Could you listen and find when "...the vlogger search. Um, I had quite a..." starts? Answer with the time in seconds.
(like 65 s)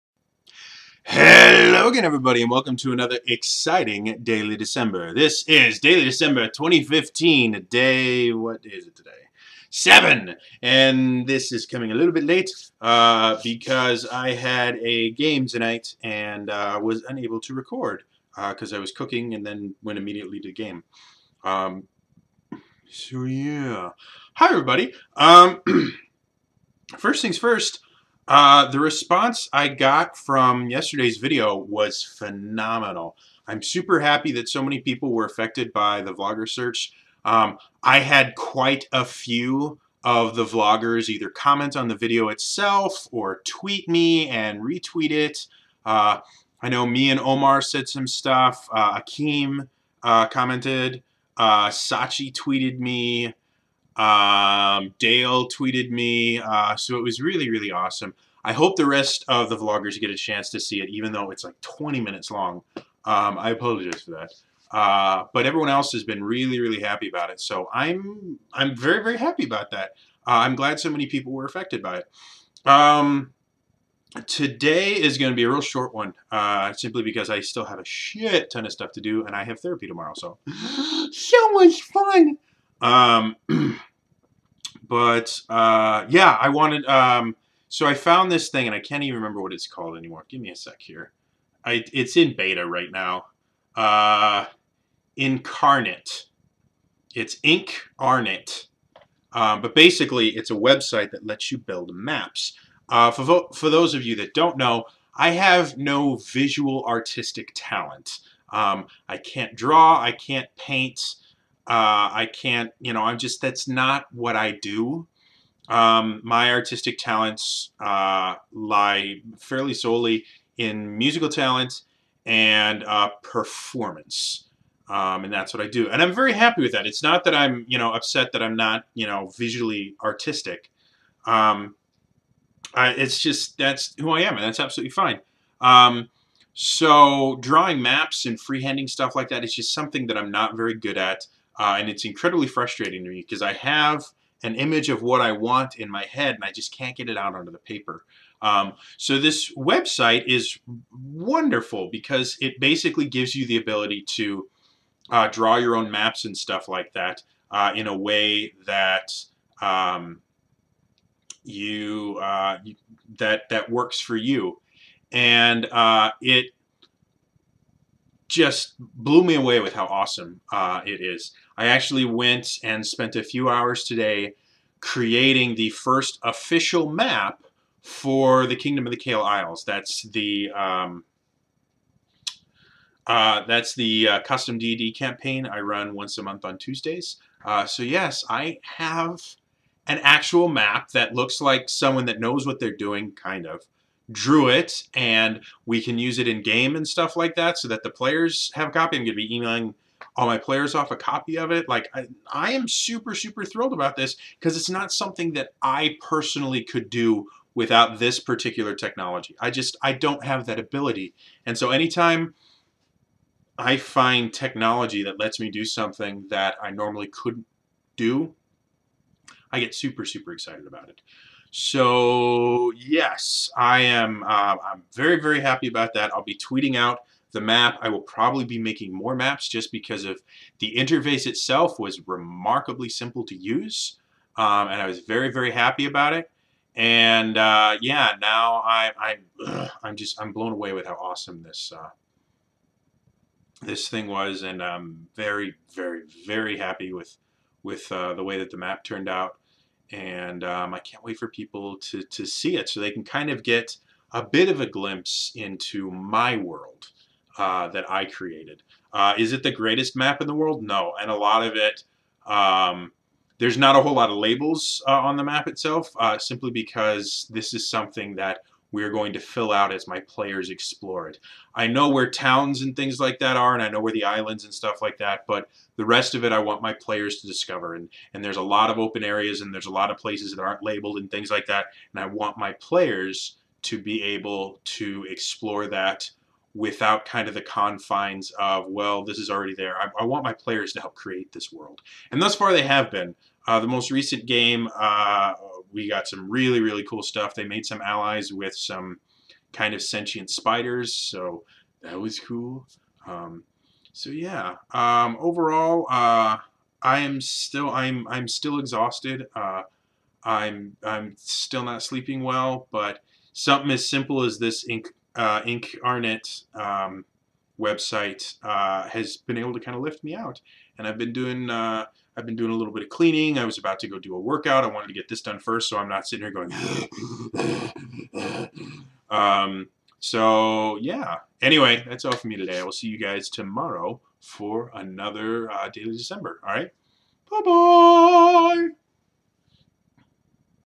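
35 s.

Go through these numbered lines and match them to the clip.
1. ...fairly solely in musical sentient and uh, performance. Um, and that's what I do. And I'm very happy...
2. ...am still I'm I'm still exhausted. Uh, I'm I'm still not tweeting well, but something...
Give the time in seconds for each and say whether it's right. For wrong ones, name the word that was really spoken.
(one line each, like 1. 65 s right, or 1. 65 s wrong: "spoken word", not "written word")
1. 119 s wrong: "talent", not "sentient"
2. 306 s wrong: "sleeping", not "tweeting".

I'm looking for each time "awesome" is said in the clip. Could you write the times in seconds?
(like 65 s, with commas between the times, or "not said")
57 s, 169 s, 240 s.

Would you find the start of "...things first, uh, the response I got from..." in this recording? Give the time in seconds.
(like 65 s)
27 s.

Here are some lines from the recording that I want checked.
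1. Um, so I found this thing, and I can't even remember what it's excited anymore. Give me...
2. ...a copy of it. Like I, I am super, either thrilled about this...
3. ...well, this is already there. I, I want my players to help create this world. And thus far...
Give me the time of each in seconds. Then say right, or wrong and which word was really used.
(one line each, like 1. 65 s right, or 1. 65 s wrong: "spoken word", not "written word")
1. 86 s wrong: "called", not "excited"
2. 200 s wrong: "super", not "either"
3. 288 s right.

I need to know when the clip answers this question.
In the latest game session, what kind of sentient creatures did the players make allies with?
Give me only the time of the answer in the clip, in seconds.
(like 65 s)
300 s.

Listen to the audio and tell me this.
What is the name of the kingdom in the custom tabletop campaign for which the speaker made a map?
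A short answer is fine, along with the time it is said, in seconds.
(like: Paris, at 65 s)
Kingdom of the Kale Isles, at 178 s.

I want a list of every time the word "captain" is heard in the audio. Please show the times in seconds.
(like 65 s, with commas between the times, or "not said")
not said.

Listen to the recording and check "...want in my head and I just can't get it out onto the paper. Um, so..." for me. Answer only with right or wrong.
right.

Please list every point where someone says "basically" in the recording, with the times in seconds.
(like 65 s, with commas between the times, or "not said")
99 s, 152 s.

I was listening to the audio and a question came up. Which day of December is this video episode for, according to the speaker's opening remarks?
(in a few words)
7.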